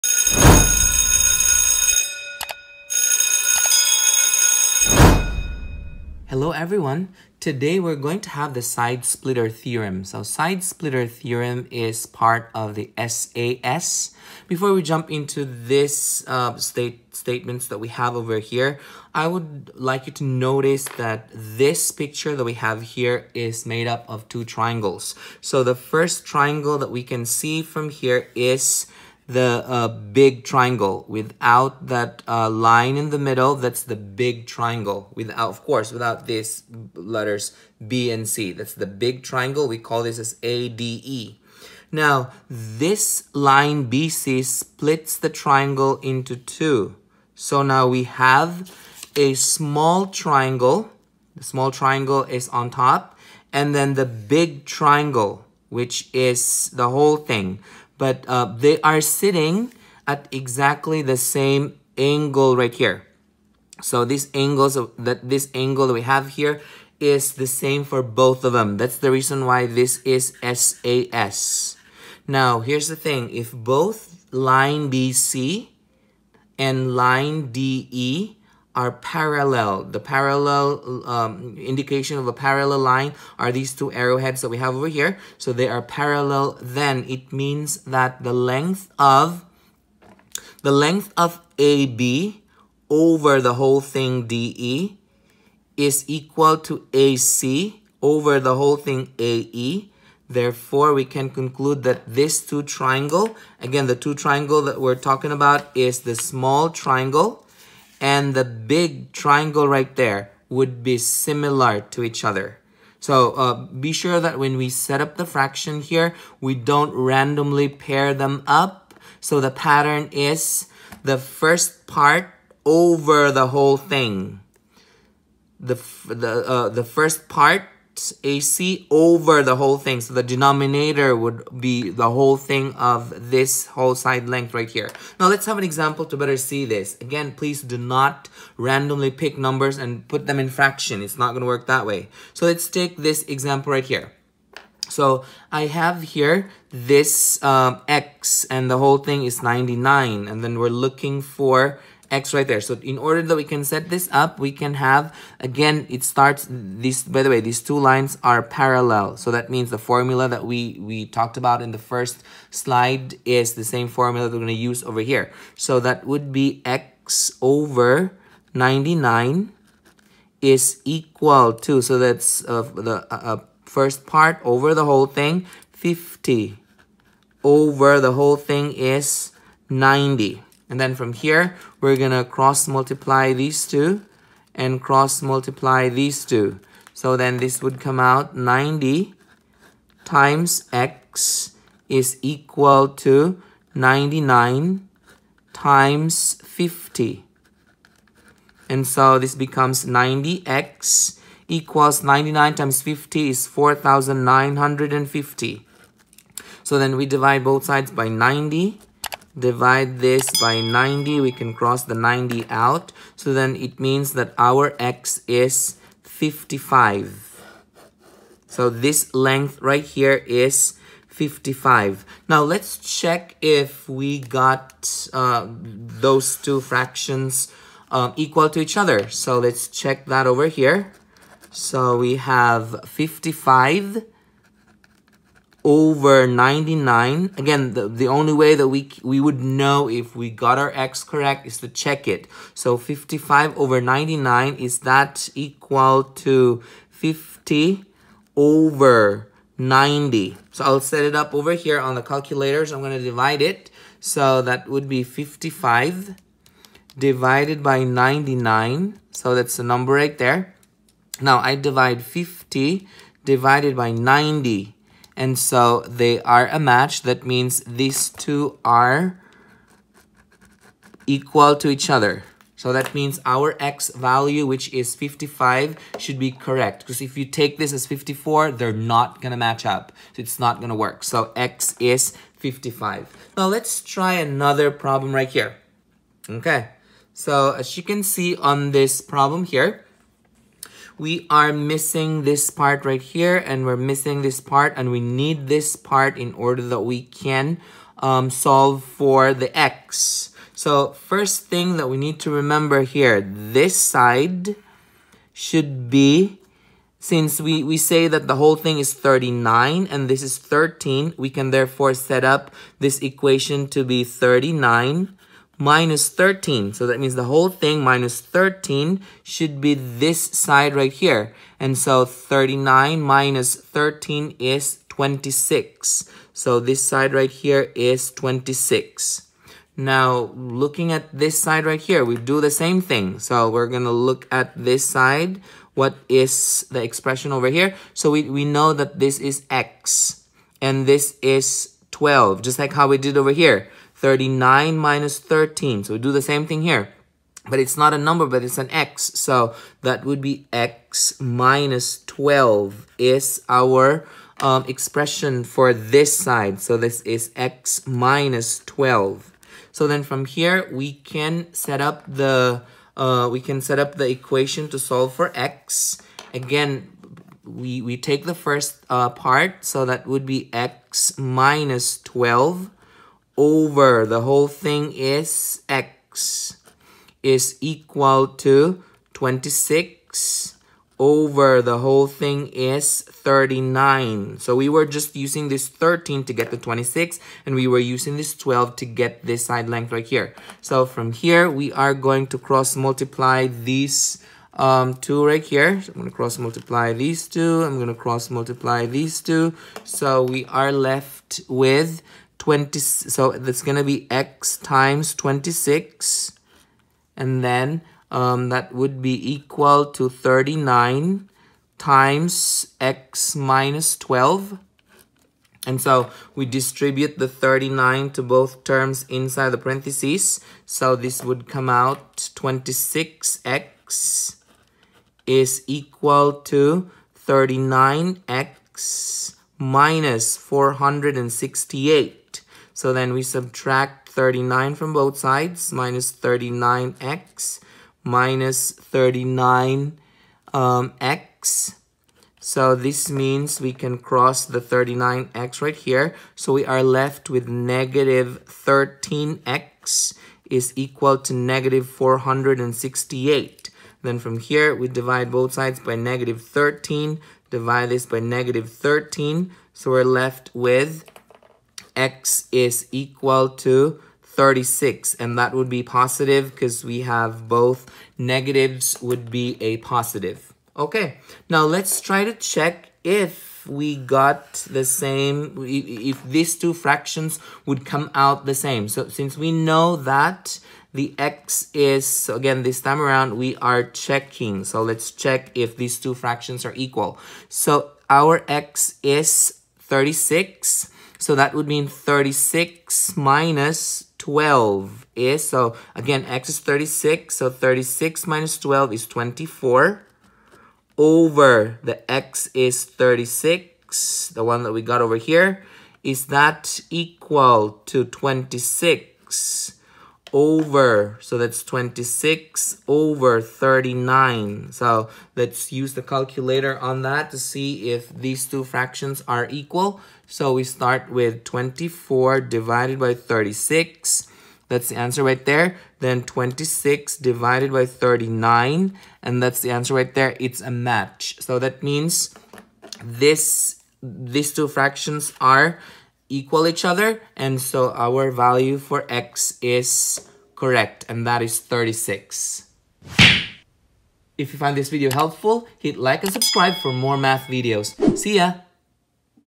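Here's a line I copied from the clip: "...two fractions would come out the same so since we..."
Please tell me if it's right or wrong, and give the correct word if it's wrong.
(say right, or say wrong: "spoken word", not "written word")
right.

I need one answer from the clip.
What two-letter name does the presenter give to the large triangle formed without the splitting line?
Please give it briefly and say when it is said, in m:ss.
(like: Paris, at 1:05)
ADE, at 0:40.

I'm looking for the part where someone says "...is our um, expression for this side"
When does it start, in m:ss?
5:52.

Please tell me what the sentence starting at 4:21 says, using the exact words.
Now I divide 50 divided by 90.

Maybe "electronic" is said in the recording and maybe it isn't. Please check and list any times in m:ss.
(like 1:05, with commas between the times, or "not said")
not said.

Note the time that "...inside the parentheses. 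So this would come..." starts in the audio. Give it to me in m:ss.
6:59.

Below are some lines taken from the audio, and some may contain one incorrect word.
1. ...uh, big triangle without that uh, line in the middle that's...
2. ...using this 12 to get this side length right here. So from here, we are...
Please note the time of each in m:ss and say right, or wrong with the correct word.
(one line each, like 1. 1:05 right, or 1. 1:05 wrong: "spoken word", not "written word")
1. 0:29 right
2. 6:27 right.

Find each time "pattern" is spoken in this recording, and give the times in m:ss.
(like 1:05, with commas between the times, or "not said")
1:59.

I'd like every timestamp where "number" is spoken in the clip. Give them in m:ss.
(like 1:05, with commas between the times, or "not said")
2:19, 4:19, 5:47.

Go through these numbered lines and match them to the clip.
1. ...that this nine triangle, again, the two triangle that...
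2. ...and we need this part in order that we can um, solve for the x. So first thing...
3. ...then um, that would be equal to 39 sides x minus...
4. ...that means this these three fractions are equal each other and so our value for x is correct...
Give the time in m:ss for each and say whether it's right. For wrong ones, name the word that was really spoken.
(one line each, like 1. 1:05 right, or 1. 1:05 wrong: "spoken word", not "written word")
1. 1:41 wrong: "two", not "nine"
2. 4:54 right
3. 6:47 wrong: "times", not "sides"
4. 8:51 wrong: "two", not "three".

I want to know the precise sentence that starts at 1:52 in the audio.
So uh, be sure that when we set up the fraction here, we don't randomly pair them up.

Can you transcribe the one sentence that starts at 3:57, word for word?
Again, the, the only way that we, we would know if we got our x correct is to check it.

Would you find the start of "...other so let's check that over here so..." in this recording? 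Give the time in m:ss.
3:48.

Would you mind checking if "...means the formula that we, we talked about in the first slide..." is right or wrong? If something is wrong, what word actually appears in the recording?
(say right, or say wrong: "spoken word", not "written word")
right.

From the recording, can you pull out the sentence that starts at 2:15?
Now let's have an example to better see this.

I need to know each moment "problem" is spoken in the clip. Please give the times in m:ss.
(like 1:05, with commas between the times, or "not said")
4:44, 4:49.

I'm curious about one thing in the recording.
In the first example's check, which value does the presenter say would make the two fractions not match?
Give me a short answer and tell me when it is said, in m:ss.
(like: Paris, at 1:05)
54, at 4:37.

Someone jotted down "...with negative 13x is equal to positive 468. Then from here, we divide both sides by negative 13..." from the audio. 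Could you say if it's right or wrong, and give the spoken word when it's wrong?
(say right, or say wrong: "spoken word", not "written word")
wrong: "negative", not "positive".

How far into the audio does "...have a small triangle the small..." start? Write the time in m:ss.
0:48.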